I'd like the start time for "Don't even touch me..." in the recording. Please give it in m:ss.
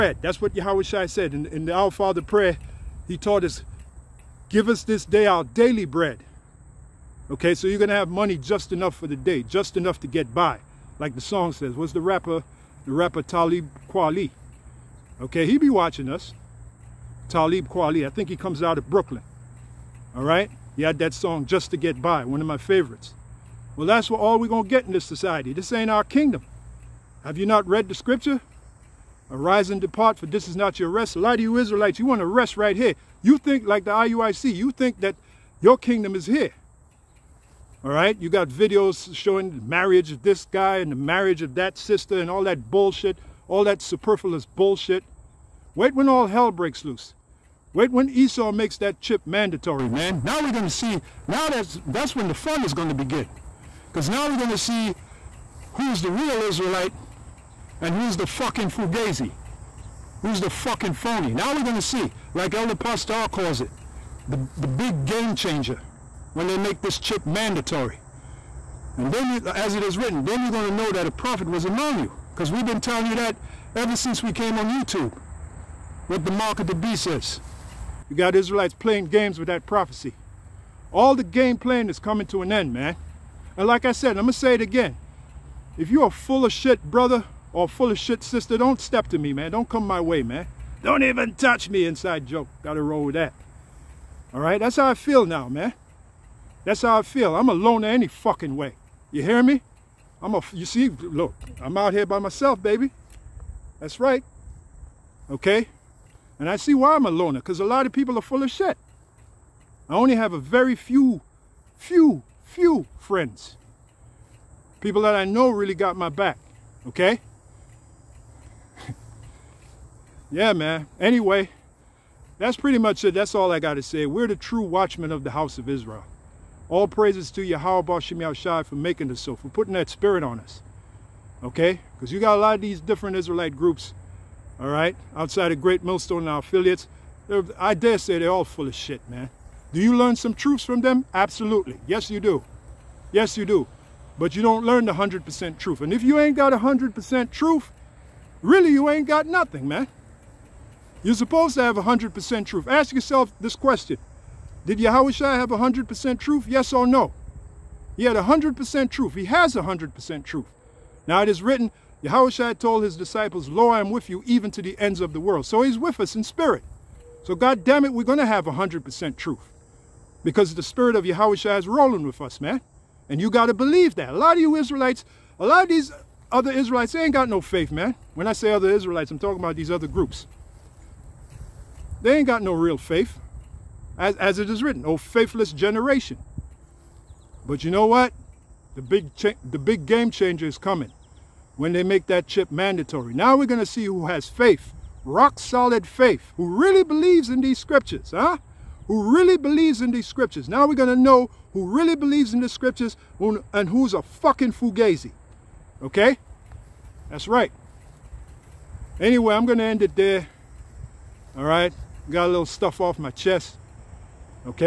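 1:30.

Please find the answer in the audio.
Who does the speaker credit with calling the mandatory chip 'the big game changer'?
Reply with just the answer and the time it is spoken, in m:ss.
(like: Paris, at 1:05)
Elder Pastor, at 1:02.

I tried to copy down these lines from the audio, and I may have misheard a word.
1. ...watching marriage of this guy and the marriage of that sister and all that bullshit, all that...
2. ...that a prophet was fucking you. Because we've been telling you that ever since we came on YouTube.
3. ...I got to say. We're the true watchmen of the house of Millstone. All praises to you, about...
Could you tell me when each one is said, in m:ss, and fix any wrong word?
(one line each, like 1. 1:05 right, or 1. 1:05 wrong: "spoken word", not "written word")
1. 0:39 wrong: "showing", not "watching"
2. 1:10 wrong: "among", not "fucking"
3. 2:03 wrong: "Israel", not "Millstone".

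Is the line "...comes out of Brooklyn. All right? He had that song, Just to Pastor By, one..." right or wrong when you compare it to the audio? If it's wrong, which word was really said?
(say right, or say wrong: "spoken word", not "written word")
wrong: "Get", not "Pastor".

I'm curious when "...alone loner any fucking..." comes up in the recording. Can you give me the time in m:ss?
1:37.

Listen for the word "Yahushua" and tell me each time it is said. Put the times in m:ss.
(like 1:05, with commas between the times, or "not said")
2:34, 2:42, 2:51.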